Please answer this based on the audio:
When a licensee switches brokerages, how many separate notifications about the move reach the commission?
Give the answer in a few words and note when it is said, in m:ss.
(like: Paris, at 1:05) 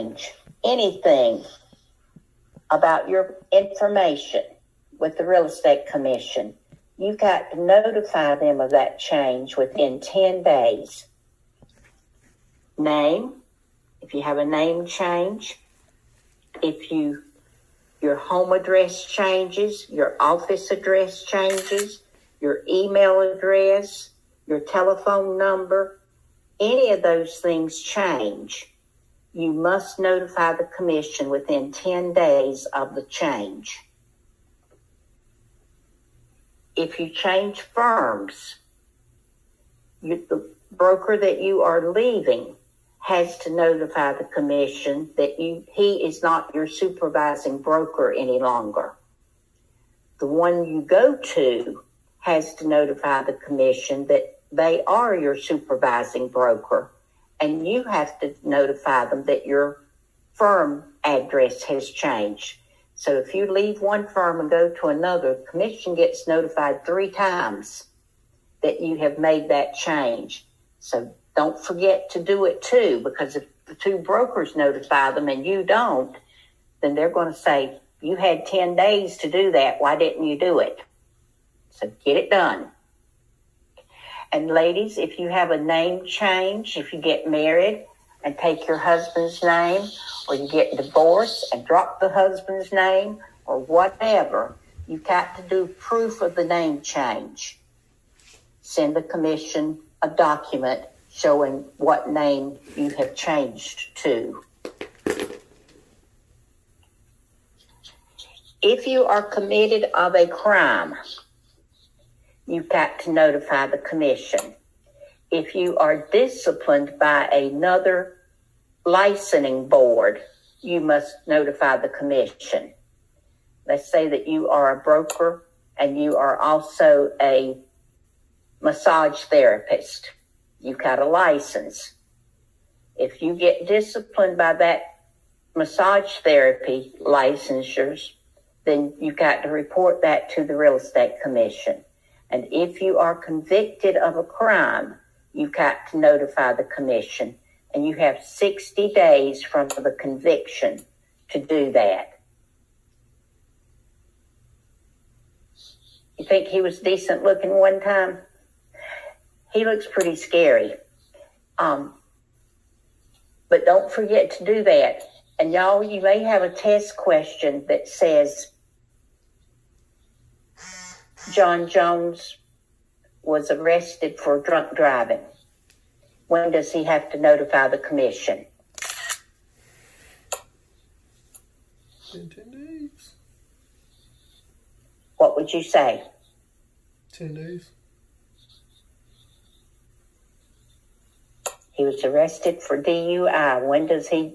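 3, at 1:06.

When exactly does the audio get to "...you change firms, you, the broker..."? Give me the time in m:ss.
0:36.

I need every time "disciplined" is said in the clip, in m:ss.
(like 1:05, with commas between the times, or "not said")
1:56, 2:13.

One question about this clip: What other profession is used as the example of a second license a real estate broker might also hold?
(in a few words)
Massage therapist.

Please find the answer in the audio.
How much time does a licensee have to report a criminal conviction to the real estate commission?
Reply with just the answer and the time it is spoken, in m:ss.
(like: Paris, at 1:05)
60 days, at 2:28.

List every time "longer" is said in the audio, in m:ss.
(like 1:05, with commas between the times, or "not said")
0:48.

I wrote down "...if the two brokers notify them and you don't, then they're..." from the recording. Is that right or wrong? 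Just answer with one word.
right.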